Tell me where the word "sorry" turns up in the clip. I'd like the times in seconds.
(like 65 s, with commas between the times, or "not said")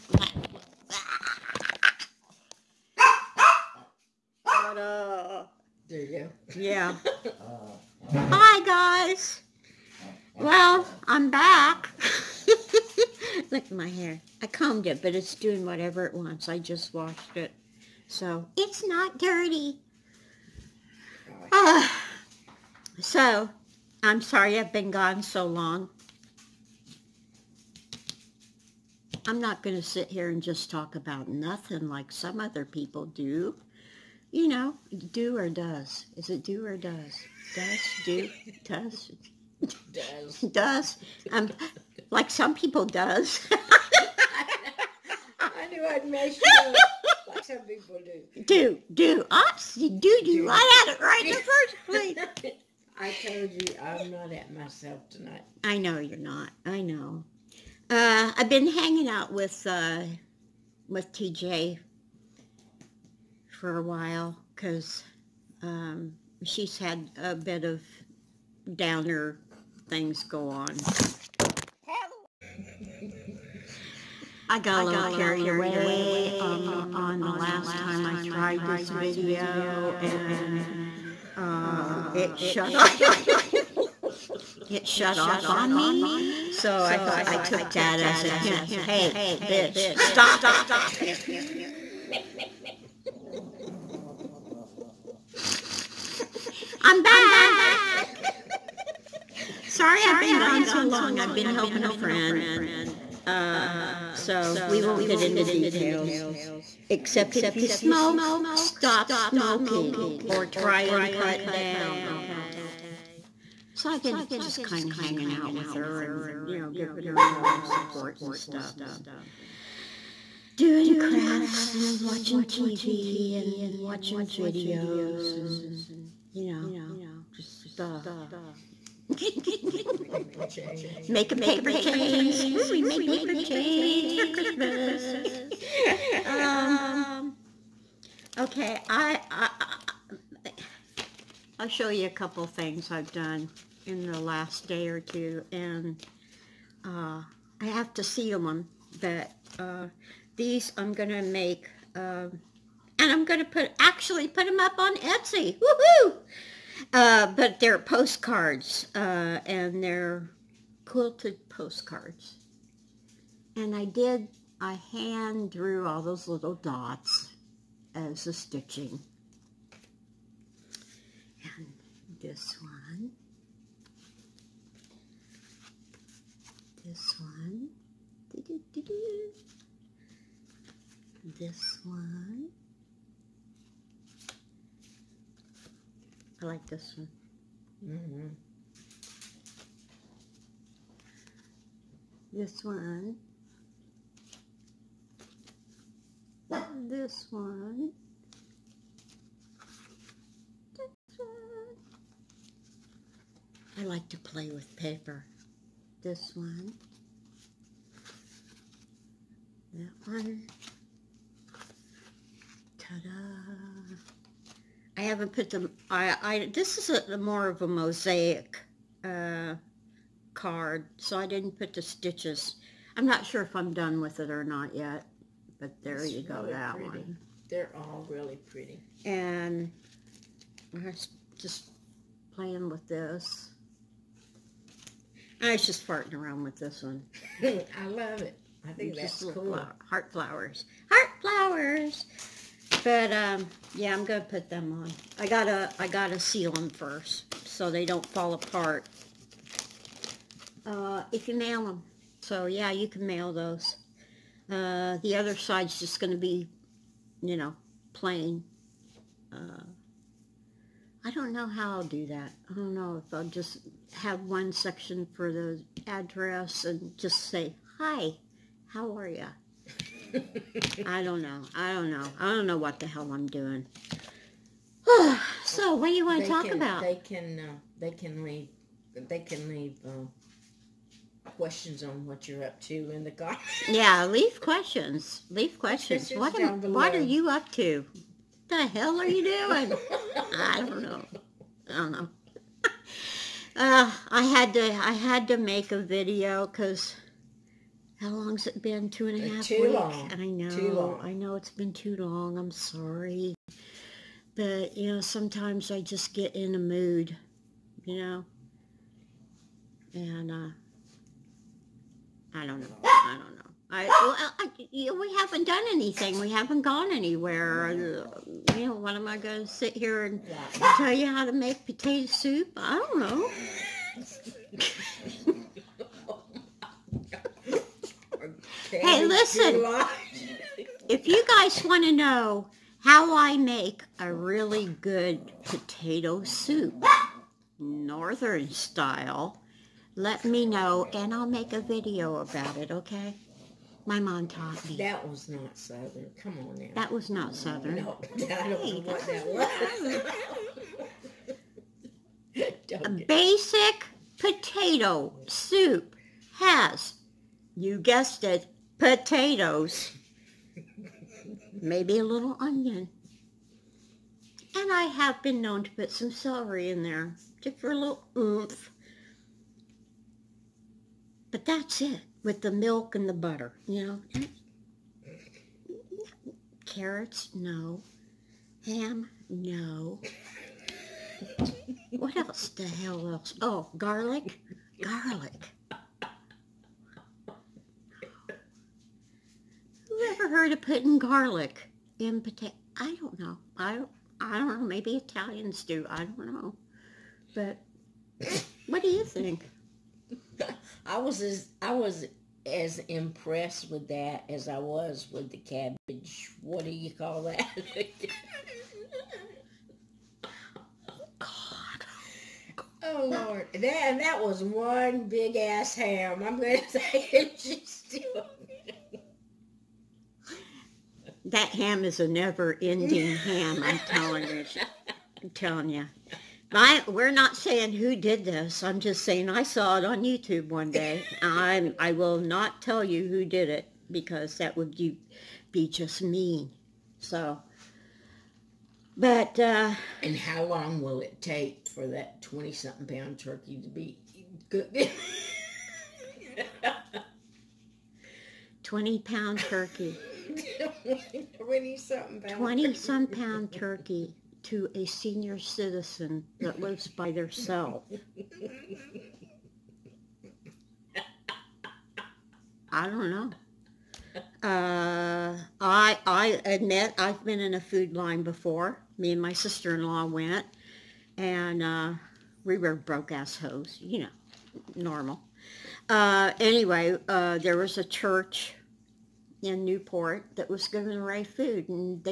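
24 s, 99 s, 302 s.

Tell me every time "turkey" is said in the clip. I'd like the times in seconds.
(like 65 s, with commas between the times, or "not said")
443 s, 449 s, 453 s.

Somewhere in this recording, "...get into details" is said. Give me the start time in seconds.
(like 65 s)
105 s.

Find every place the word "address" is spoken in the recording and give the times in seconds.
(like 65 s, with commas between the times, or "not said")
265 s.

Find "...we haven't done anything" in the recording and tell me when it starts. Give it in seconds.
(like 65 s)
314 s.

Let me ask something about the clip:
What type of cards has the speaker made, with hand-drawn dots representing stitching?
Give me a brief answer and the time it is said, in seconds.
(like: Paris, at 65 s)
Quilted postcards, at 160 s.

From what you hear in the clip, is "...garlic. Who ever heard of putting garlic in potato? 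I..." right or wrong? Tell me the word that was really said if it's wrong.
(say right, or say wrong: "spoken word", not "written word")
right.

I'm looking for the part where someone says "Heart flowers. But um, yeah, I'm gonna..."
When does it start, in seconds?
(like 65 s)
240 s.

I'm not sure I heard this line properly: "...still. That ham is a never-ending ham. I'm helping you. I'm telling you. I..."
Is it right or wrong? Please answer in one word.
wrong.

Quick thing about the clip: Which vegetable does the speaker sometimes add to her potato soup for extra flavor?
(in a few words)
Celery.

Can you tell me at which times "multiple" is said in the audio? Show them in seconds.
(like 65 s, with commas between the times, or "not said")
not said.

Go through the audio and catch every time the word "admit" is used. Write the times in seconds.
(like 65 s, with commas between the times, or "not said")
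466 s.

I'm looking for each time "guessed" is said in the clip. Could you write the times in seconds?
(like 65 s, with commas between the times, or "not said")
357 s.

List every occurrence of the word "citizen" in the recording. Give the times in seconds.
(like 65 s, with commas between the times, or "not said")
455 s.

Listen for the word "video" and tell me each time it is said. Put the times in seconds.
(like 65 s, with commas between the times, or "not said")
78 s, 124 s, 295 s, 341 s.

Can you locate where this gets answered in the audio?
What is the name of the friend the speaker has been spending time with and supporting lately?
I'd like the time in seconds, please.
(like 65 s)
61 s.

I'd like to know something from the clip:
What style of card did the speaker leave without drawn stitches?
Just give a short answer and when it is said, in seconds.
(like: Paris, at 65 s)
Mosaic, at 217 s.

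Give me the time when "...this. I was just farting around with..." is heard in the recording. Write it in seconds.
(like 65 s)
232 s.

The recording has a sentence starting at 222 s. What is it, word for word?
I'm not sure if I'm done with it or not yet, but there it's you go, really that pretty.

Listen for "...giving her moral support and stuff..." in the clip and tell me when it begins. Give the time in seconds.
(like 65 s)
116 s.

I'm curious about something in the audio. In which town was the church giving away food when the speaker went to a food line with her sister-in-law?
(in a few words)
Newport.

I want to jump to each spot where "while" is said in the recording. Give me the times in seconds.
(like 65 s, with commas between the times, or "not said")
63 s.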